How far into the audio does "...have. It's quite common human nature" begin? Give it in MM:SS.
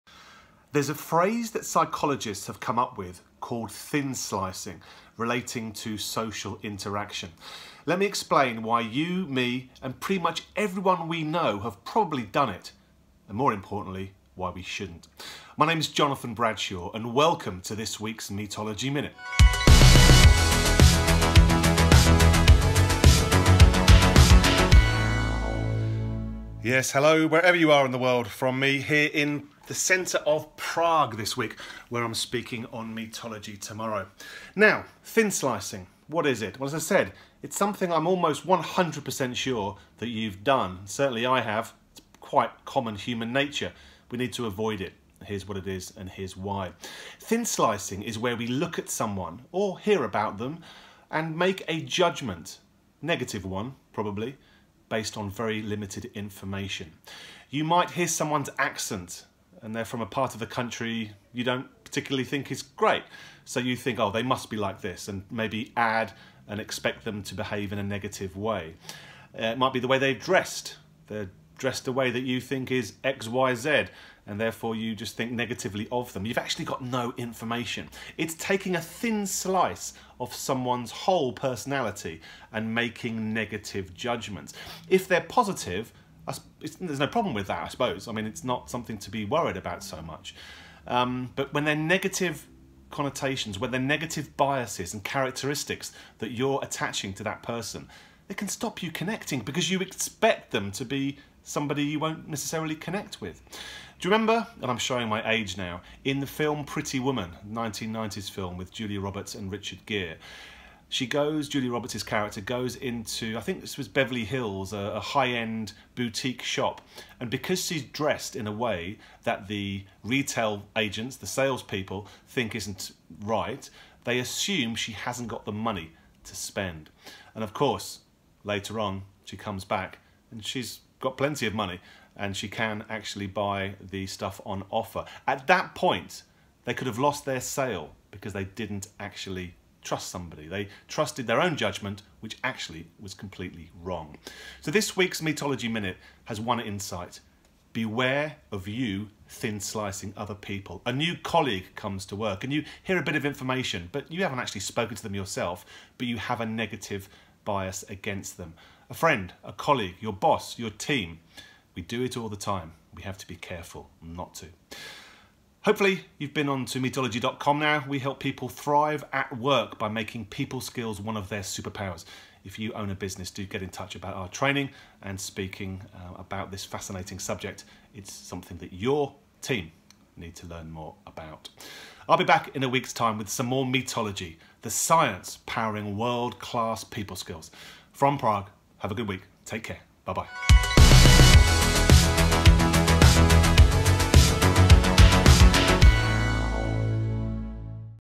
00:41.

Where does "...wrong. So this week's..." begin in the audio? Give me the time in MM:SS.
02:23.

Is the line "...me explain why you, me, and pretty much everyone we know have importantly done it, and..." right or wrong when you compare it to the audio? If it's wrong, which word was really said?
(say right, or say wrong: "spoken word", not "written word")
wrong: "probably", not "importantly".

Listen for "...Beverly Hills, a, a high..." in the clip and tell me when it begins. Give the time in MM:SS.
01:53.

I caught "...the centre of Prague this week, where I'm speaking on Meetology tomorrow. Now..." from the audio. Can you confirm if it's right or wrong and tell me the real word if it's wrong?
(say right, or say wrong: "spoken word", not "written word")
right.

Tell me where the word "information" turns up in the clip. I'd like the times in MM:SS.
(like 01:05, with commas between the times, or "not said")
00:56, 01:17, 02:33.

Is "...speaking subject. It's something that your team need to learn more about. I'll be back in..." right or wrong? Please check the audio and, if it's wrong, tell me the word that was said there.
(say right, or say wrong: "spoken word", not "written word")
wrong: "fascinating", not "speaking".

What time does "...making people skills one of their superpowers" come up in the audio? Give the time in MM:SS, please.
02:49.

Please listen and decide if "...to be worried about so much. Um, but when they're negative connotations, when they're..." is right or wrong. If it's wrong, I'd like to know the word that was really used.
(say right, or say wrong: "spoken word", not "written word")
right.